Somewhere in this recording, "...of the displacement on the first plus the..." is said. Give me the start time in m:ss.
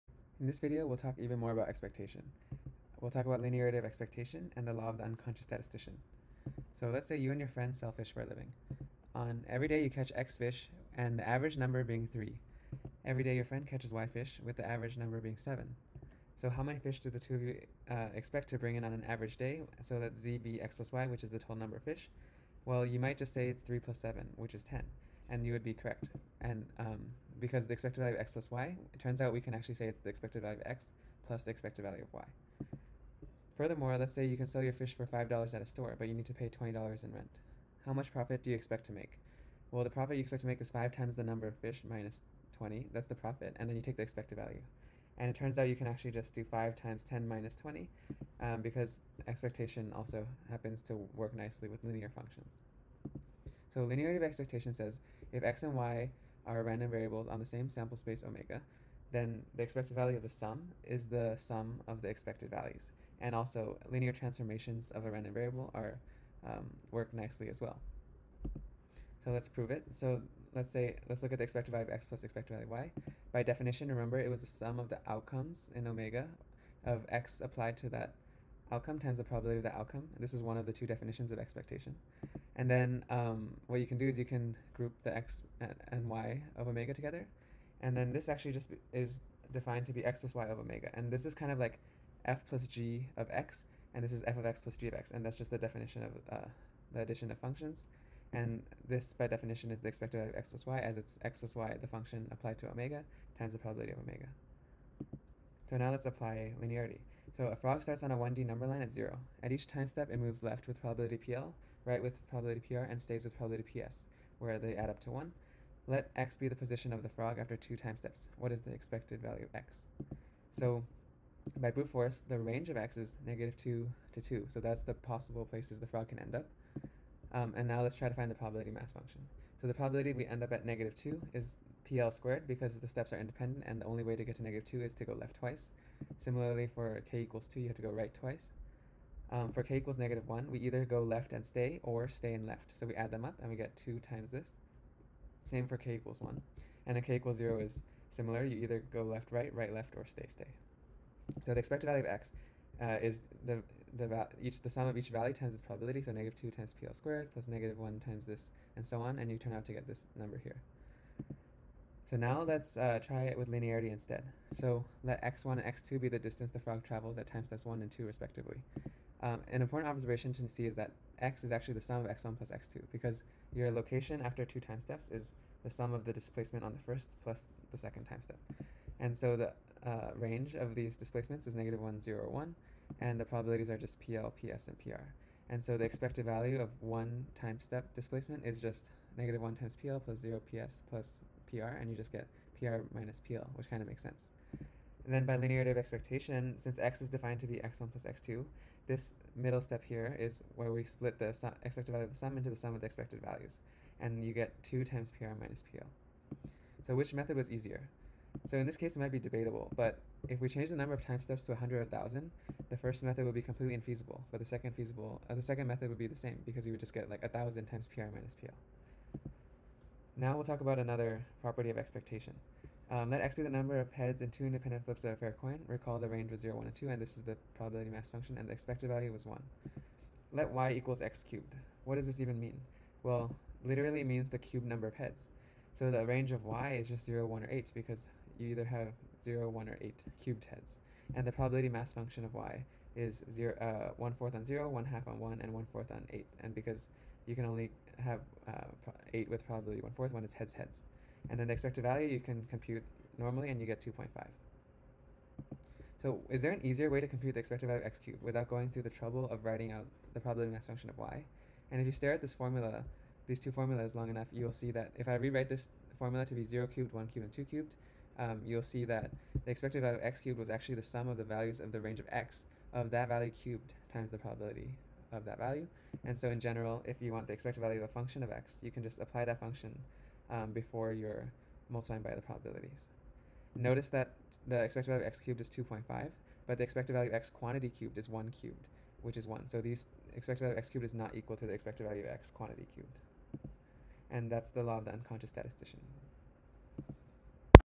2:55.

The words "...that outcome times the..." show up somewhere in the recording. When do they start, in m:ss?
1:17.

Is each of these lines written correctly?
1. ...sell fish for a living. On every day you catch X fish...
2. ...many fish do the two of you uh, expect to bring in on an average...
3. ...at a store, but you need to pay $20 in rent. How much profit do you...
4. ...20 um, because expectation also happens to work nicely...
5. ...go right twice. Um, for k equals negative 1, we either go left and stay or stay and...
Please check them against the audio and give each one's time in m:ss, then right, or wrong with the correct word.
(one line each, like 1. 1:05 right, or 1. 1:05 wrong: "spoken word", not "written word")
1. 0:07 right
2. 0:16 right
3. 0:35 right
4. 0:47 right
5. 2:17 right.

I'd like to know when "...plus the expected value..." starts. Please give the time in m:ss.
0:31.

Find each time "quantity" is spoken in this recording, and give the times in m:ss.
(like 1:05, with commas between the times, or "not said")
4:47, 4:52.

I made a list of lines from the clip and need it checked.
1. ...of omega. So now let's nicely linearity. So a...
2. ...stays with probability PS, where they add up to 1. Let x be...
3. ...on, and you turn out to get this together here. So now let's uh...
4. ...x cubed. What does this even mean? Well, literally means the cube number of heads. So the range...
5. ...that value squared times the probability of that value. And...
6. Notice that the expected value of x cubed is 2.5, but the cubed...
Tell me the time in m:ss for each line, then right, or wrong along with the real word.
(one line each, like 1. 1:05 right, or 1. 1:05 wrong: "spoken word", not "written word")
1. 1:43 wrong: "apply", not "nicely"
2. 1:53 right
3. 2:39 wrong: "number", not "together"
4. 3:51 right
5. 4:32 wrong: "cubed", not "squared"
6. 4:43 wrong: "expected", not "cubed".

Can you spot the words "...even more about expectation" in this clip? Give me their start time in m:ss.
0:01.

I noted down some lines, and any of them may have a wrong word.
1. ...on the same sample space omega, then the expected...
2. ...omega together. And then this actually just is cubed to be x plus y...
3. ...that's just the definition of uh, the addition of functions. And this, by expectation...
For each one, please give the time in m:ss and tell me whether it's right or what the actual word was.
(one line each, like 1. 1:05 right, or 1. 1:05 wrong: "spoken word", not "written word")
1. 0:57 right
2. 1:26 wrong: "defined", not "cubed"
3. 1:35 wrong: "definition", not "expectation".